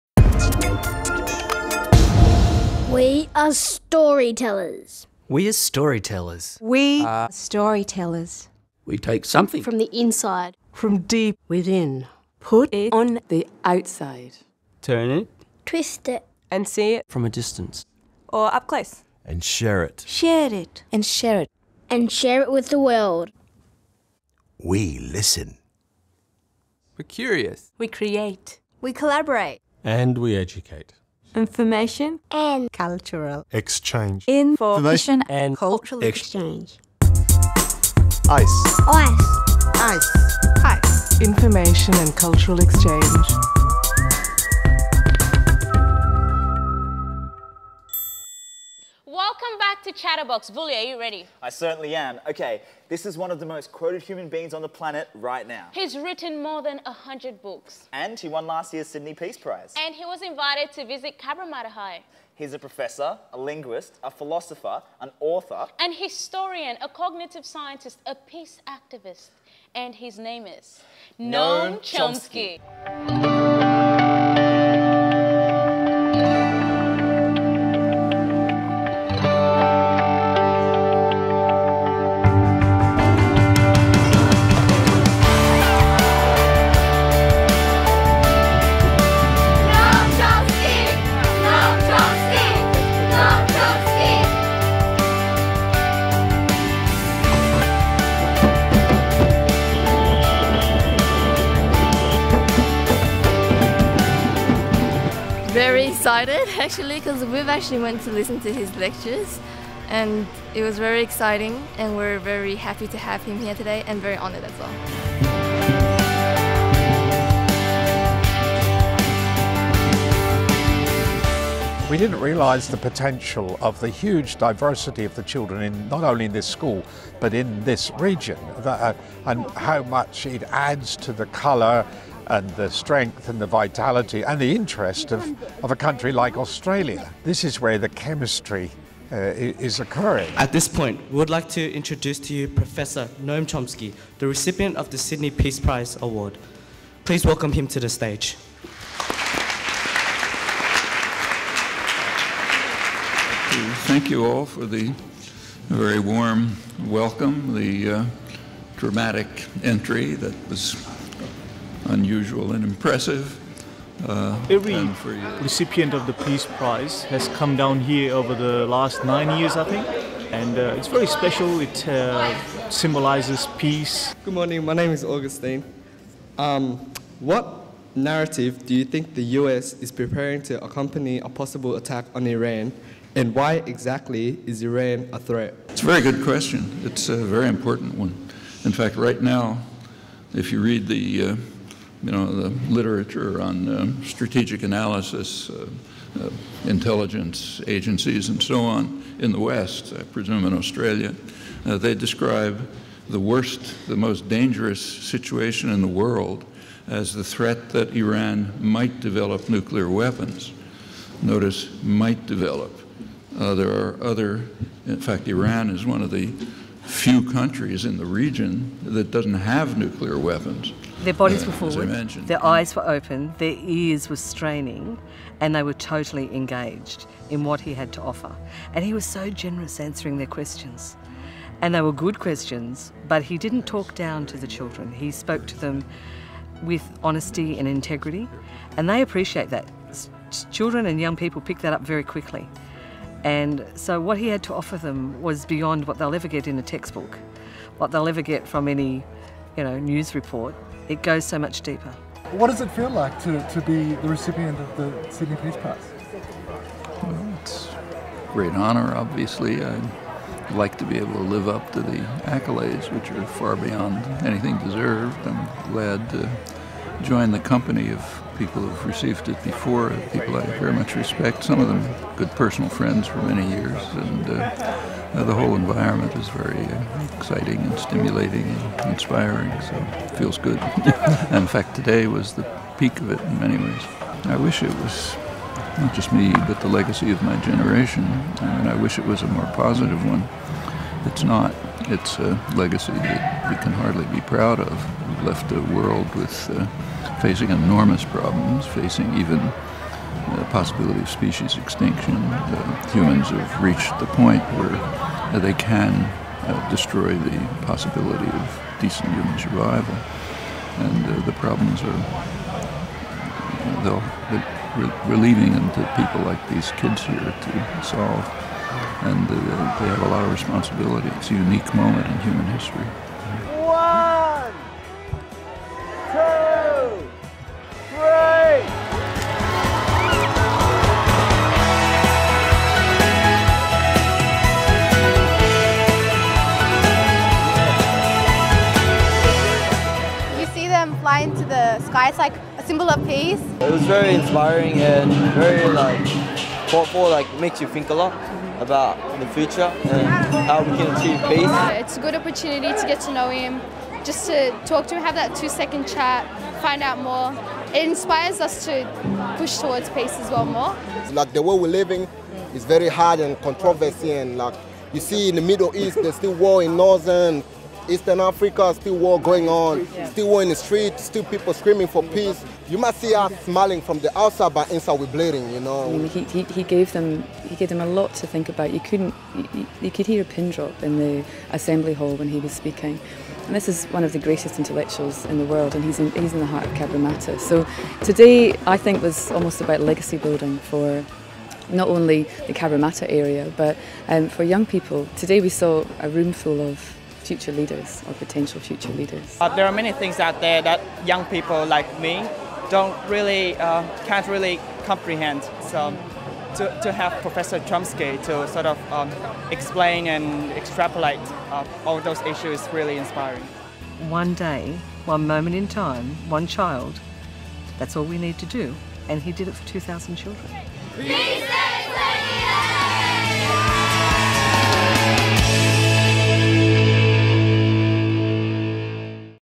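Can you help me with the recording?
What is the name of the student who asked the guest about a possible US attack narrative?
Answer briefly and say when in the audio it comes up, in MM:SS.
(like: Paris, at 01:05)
Augustine, at 02:55.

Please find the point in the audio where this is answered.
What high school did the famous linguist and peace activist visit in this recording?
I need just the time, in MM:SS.
01:01.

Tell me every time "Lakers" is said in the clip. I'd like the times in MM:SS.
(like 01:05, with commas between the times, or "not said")
not said.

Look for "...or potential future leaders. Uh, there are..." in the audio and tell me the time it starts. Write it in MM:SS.
06:38.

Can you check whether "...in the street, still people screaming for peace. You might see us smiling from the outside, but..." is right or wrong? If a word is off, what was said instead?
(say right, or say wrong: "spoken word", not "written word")
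right.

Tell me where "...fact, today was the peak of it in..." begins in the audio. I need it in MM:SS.
04:41.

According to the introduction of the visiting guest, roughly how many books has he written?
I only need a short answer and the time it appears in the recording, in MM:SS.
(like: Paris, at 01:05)
more than 100, at 00:56.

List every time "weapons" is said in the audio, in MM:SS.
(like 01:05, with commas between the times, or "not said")
03:29, 03:40.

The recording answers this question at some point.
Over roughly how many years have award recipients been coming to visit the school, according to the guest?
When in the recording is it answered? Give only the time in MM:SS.
02:49.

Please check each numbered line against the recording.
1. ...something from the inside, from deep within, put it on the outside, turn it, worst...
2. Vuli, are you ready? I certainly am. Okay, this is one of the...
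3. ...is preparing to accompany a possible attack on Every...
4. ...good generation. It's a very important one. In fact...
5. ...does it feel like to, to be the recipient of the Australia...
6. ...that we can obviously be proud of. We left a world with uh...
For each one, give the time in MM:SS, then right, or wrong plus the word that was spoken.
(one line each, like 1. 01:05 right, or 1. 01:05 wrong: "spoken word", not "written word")
1. 00:09 wrong: "twist", not "worst"
2. 00:50 right
3. 02:59 wrong: "Iran", not "Every"
4. 03:06 wrong: "question", not "generation"
5. 04:12 wrong: "Sydney", not "Australia"
6. 04:52 wrong: "hardly", not "obviously".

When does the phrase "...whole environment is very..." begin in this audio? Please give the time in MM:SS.
04:35.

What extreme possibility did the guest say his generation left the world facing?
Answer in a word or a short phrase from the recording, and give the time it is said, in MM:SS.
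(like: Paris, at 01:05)
species extinction, at 05:01.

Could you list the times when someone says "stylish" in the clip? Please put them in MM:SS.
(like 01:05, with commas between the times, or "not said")
not said.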